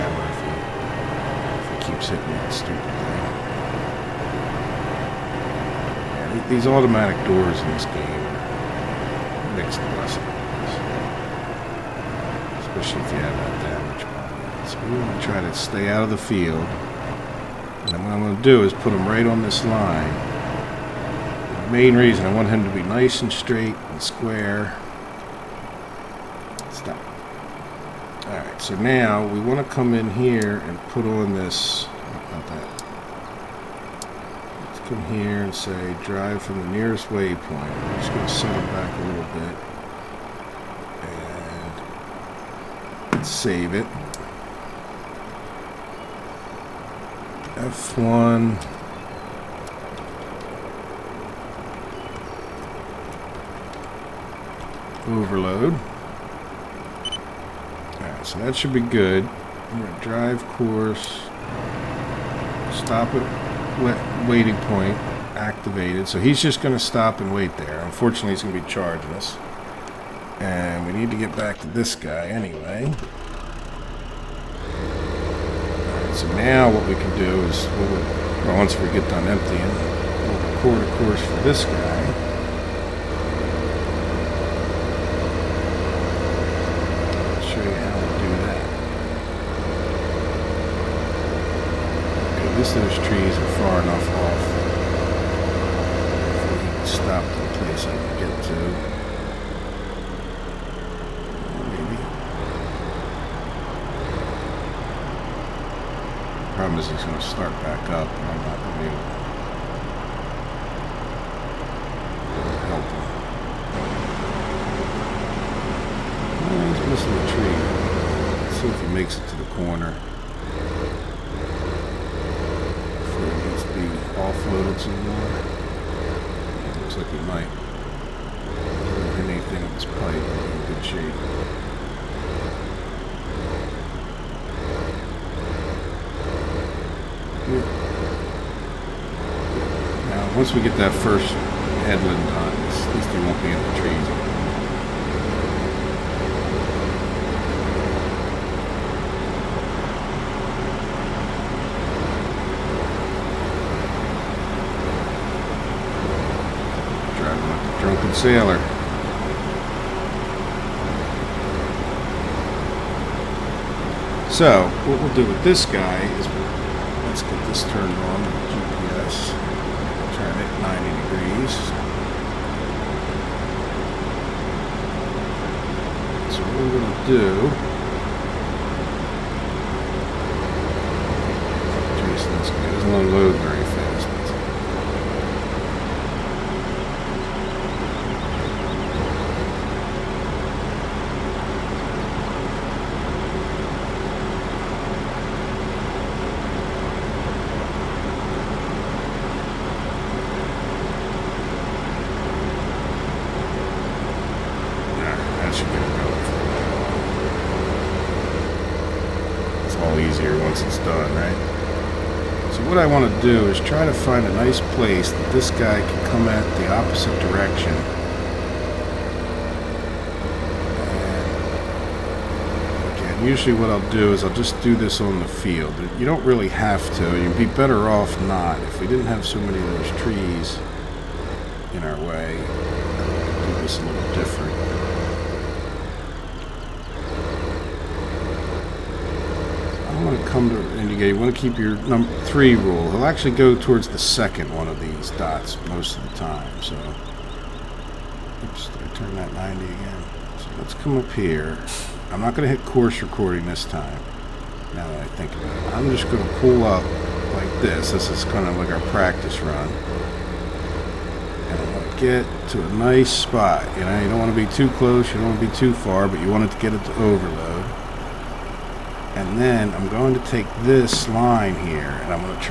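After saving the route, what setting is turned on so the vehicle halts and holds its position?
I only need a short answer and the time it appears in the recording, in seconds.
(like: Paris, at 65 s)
Stop at waiting point, at 62 s.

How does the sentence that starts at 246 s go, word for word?
So, oops, I turned that 90 again.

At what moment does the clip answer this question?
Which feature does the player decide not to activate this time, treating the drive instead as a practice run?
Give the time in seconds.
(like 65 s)
252 s.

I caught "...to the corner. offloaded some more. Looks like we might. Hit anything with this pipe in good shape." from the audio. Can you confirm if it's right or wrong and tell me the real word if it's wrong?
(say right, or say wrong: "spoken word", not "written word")
right.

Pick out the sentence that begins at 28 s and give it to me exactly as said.
So now we want to come in here and put on this, not that.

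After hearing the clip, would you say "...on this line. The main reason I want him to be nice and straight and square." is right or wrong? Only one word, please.
right.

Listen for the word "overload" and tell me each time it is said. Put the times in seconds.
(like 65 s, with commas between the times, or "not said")
55 s, 267 s.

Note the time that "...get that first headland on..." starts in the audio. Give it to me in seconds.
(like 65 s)
140 s.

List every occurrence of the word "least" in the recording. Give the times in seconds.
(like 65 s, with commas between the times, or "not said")
92 s, 142 s.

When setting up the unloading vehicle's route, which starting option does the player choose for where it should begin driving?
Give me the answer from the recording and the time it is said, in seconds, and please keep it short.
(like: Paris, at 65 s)
Drive from the nearest waypoint, at 36 s.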